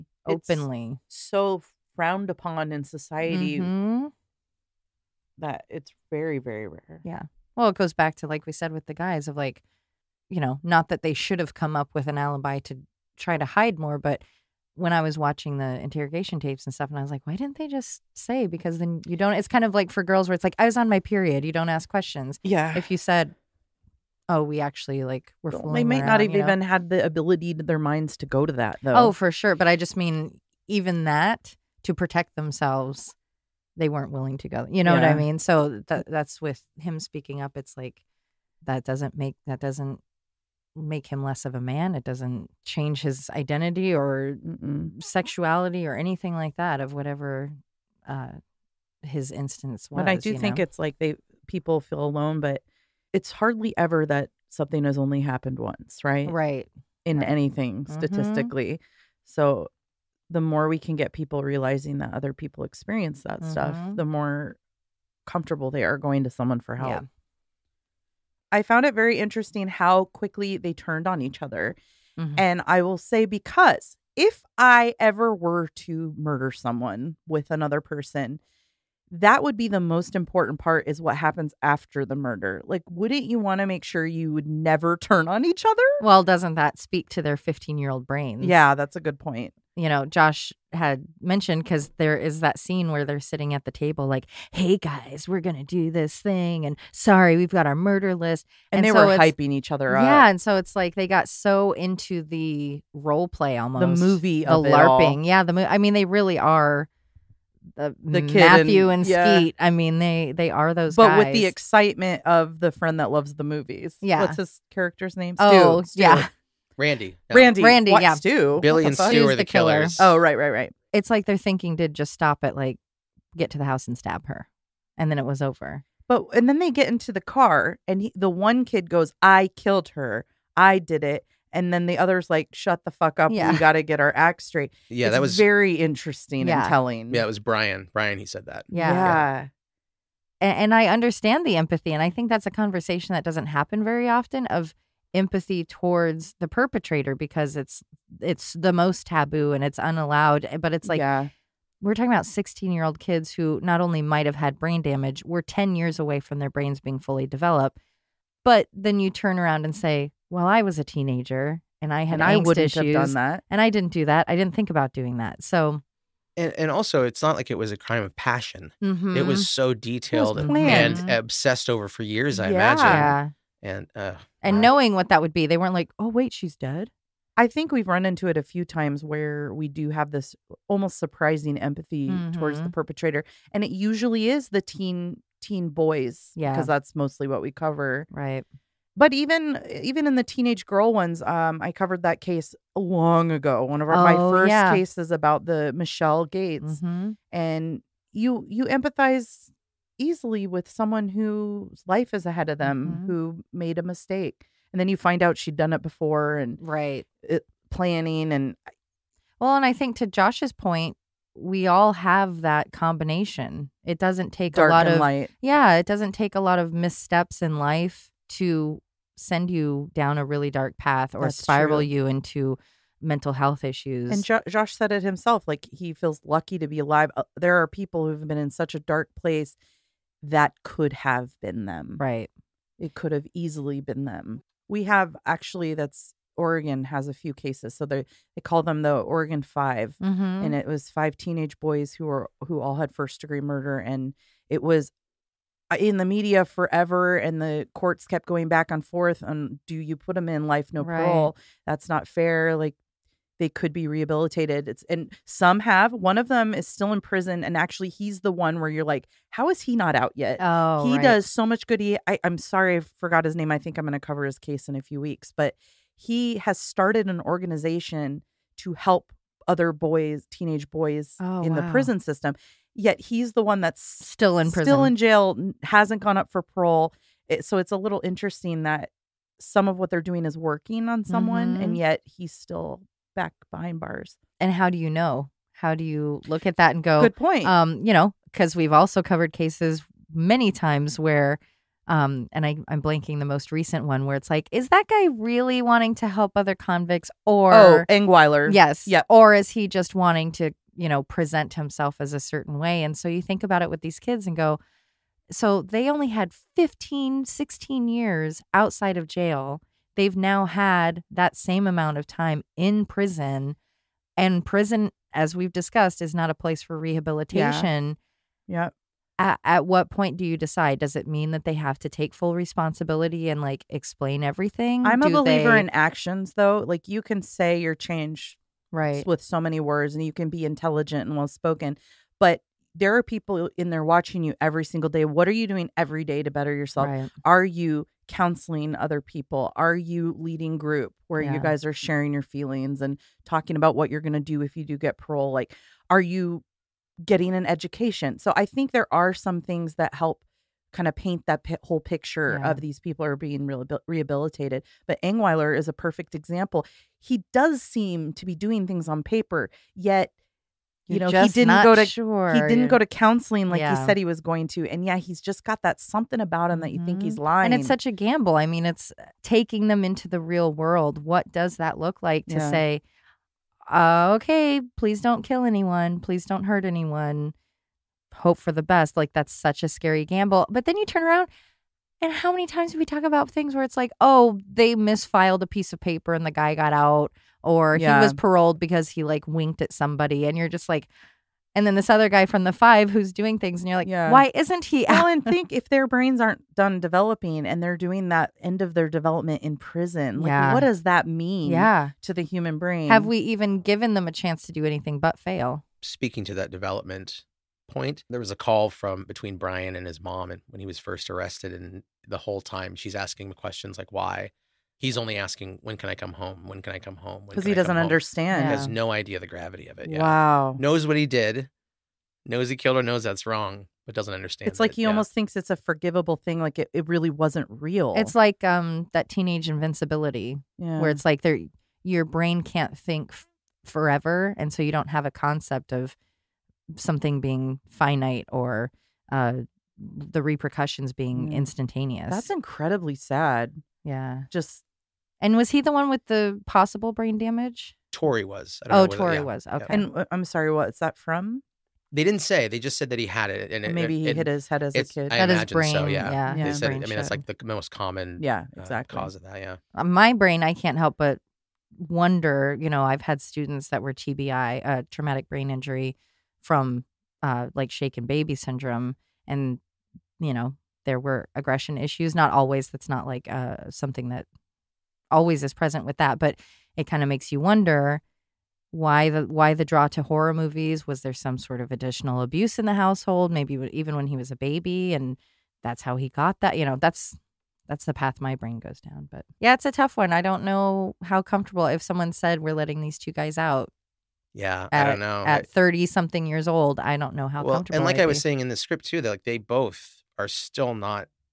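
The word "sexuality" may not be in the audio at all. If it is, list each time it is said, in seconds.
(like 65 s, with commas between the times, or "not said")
45 s.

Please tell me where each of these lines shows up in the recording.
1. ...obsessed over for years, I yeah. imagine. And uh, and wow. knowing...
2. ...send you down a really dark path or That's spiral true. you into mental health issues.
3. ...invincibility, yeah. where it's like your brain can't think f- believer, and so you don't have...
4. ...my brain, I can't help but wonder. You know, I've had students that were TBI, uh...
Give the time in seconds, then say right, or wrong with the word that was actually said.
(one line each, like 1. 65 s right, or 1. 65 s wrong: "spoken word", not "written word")
1. 171 s right
2. 219 s right
3. 429 s wrong: "forever", not "believer"
4. 459 s right.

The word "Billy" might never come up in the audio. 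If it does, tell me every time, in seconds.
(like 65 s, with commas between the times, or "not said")
118 s.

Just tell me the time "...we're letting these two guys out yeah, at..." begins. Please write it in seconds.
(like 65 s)
492 s.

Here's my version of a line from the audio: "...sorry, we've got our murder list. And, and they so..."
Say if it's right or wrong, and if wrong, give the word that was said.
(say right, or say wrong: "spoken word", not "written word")
right.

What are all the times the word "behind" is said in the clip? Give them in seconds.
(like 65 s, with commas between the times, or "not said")
283 s.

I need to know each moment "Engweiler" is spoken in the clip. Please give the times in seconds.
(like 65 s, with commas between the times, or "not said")
297 s, 355 s.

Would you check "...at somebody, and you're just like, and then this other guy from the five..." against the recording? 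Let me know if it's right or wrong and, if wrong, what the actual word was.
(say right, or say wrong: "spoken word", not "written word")
right.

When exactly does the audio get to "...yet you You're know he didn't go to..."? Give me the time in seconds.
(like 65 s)
359 s.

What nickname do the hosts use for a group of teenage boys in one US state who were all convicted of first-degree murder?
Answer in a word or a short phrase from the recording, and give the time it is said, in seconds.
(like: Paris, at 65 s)
Oregon 5, at 238 s.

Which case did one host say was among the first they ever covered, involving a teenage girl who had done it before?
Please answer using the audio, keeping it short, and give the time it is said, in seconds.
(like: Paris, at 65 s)
Michelle Gates, at 195 s.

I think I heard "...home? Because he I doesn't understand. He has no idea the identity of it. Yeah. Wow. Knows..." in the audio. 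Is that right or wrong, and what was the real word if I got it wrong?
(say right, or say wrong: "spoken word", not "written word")
wrong: "gravity", not "identity".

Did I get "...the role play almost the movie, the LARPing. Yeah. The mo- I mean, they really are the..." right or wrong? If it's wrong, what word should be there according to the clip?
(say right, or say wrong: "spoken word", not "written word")
right.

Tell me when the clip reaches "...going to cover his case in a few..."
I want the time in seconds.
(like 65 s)
263 s.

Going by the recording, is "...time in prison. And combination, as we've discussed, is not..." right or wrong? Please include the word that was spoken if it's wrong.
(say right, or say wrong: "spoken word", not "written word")
wrong: "prison", not "combination".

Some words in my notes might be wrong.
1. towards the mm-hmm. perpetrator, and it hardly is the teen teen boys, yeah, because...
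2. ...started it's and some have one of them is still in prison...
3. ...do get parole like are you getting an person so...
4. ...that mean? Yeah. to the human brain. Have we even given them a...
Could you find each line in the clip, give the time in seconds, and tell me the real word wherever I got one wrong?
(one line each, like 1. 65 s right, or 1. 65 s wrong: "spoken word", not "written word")
1. 182 s wrong: "usually", not "hardly"
2. 253 s wrong: "rehabilitated", not "started"
3. 344 s wrong: "education", not "person"
4. 400 s right.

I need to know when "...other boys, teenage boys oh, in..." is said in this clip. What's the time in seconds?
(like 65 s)
269 s.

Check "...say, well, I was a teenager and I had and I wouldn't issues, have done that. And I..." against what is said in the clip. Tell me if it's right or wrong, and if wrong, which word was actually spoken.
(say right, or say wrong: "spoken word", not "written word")
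right.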